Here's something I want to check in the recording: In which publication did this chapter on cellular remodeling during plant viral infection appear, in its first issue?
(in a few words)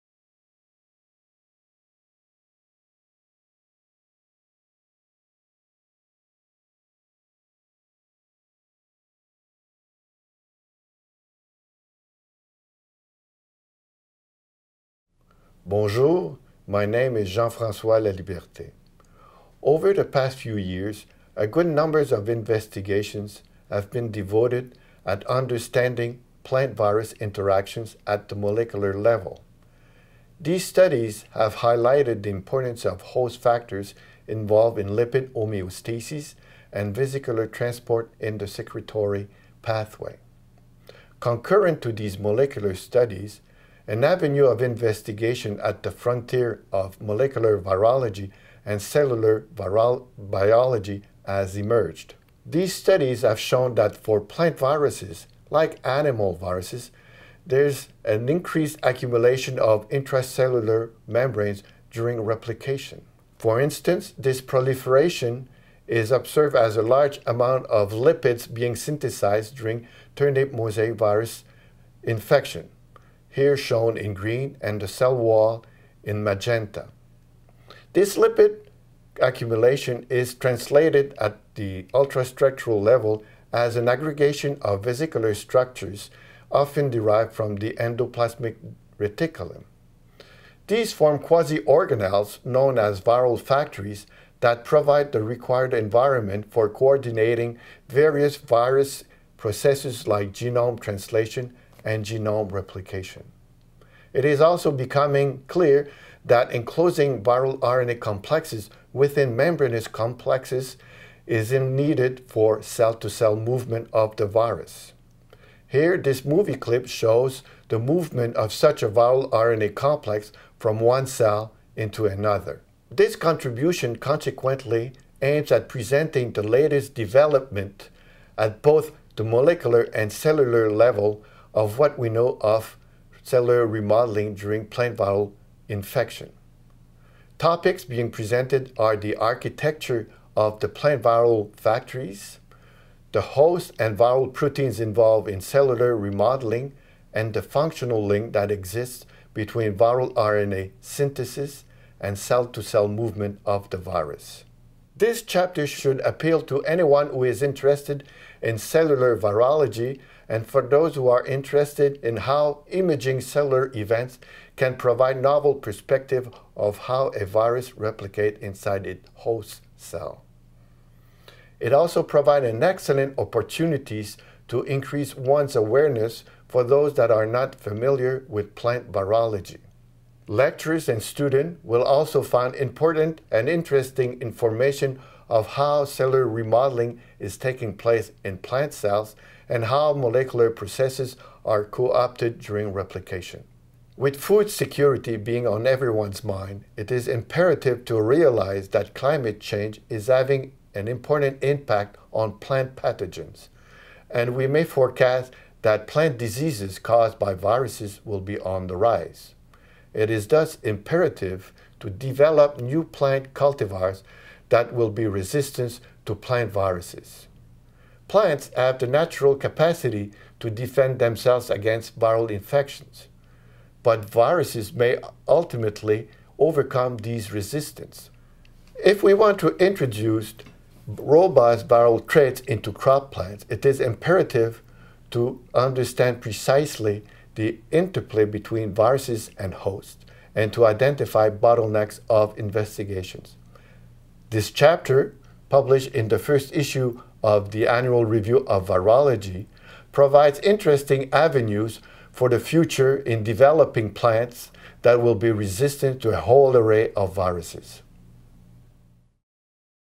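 Annual Review of Virology.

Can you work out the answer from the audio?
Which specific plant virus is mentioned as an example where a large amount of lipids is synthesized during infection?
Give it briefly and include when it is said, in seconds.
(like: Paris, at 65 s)
turnip mosaic virus, at 70 s.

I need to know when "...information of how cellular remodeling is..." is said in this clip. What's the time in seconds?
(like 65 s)
184 s.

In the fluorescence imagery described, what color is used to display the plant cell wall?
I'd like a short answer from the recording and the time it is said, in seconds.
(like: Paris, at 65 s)
magenta, at 76 s.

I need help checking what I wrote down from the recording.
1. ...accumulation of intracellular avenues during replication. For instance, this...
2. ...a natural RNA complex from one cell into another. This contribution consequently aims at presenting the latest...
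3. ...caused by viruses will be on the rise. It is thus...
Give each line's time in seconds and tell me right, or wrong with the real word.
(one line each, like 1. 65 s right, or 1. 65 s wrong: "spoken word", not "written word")
1. 58 s wrong: "membranes", not "avenues"
2. 118 s wrong: "viral", not "natural"
3. 206 s right.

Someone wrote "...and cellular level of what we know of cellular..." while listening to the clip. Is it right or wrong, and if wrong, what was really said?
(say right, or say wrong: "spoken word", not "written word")
right.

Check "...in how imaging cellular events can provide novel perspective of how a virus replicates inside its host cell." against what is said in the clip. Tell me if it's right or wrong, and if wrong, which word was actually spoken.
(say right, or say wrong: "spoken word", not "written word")
right.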